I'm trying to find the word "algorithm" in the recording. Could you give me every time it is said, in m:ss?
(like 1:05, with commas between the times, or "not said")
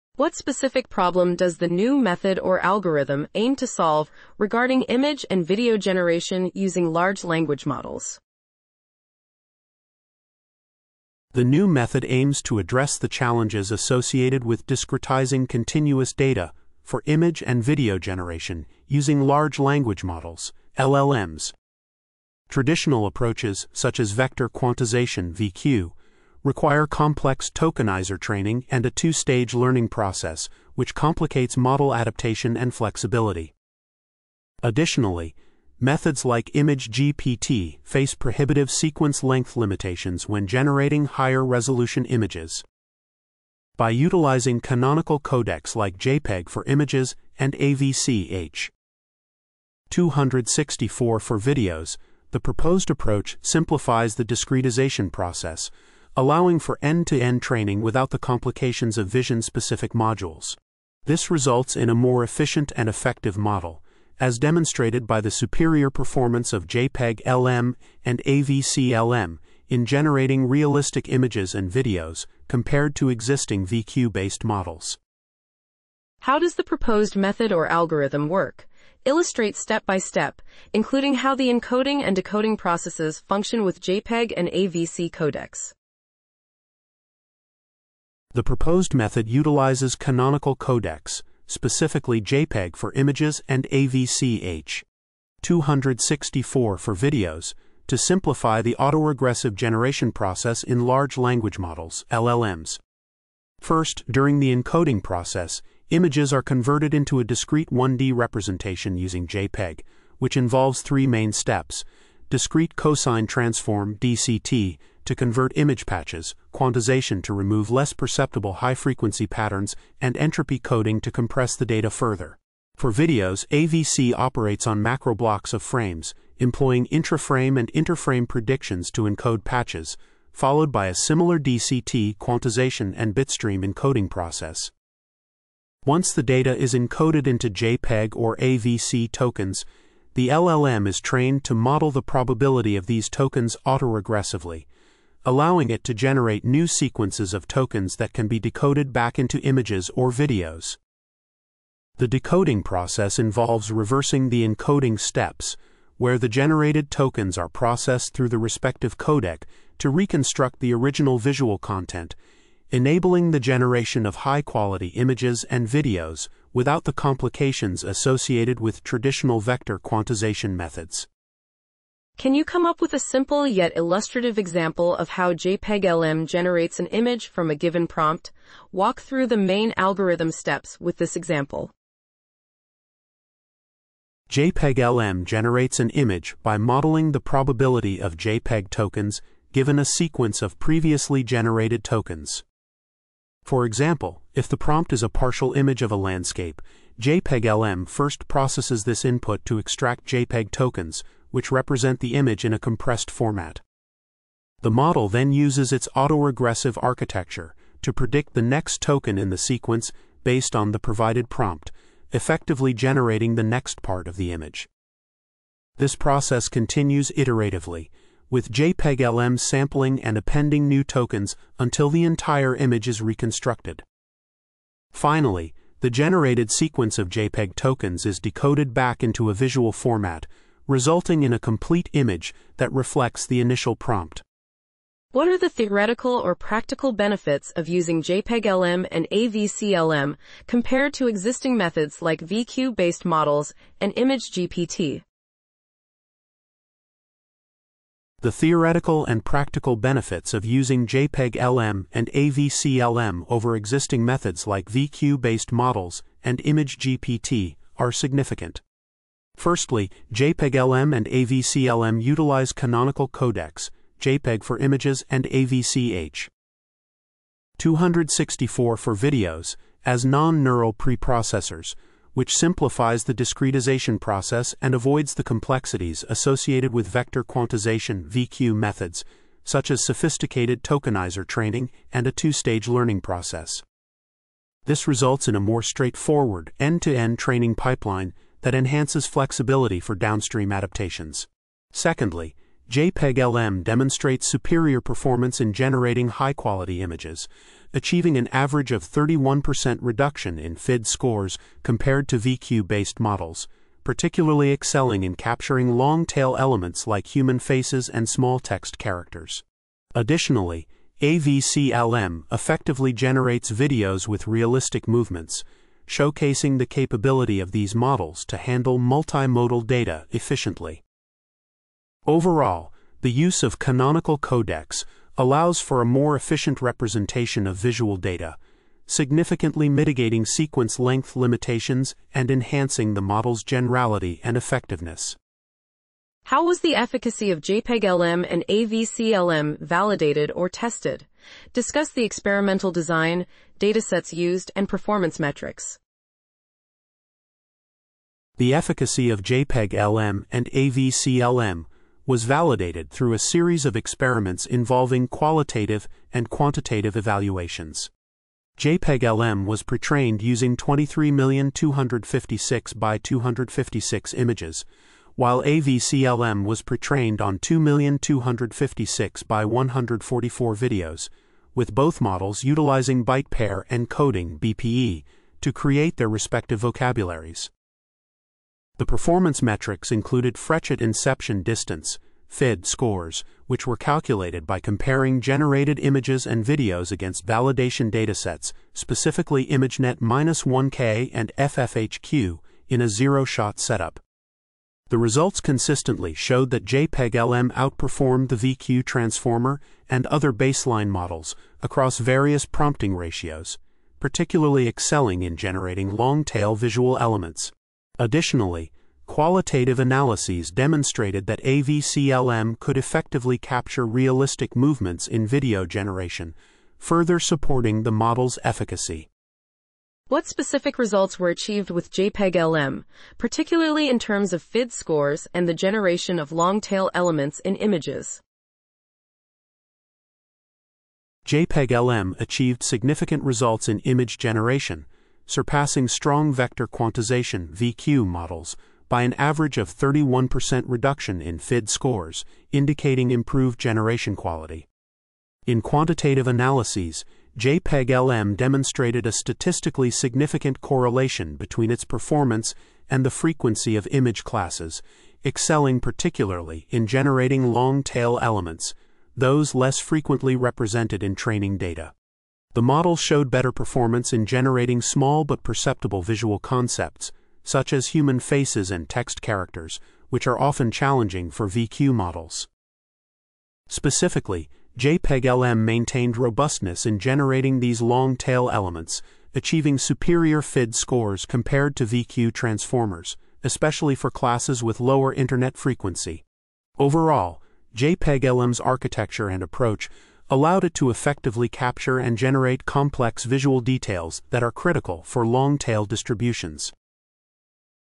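0:02, 1:17, 2:59.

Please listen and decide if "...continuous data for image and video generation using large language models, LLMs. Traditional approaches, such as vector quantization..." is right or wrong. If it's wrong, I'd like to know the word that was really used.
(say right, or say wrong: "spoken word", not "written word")
right.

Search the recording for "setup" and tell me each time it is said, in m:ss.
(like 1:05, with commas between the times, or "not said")
6:33.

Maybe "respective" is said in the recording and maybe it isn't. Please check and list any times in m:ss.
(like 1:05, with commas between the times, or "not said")
2:38, 6:16.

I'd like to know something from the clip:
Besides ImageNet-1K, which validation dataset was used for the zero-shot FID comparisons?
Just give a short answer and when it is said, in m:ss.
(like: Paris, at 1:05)
FFHQ, at 6:31.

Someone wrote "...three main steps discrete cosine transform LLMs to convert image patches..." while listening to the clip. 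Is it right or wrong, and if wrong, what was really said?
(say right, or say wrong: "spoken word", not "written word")
wrong: "DCT", not "LLMs".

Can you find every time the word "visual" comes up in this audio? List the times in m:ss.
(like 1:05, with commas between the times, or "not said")
2:41, 3:49, 5:27, 6:46, 7:46, 8:13.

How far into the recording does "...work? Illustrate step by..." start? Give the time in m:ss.
1:18.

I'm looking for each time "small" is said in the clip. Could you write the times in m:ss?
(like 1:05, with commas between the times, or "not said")
5:08, 7:44.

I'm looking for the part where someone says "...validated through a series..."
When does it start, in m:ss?
5:52.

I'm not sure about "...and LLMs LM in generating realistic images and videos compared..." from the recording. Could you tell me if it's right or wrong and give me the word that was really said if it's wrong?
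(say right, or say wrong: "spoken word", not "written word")
wrong: "AVC", not "LLMs".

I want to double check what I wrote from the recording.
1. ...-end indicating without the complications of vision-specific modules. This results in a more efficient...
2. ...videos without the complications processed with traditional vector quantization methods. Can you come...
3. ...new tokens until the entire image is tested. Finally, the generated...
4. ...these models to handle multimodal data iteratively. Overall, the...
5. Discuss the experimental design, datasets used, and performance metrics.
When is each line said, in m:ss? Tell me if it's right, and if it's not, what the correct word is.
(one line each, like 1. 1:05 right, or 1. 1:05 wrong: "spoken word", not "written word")
1. 0:57 wrong: "training", not "indicating"
2. 2:45 wrong: "associated", not "processed"
3. 3:40 wrong: "reconstructed", not "tested"
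4. 5:17 wrong: "efficiently", not "iteratively"
5. 5:41 right.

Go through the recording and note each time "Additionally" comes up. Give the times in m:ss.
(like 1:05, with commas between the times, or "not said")
0:34, 5:09, 6:47.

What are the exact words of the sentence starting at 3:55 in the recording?
What are the theoretical or practical benefits of using JPEG-LM and AVCLM compared to existing methods like VQ-based models and ImageGPT?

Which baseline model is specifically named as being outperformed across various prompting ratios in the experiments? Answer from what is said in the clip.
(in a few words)
VQ transformer.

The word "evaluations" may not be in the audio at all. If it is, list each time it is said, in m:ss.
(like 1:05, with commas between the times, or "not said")
5:56.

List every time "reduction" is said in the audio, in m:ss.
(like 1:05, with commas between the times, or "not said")
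4:59, 7:20.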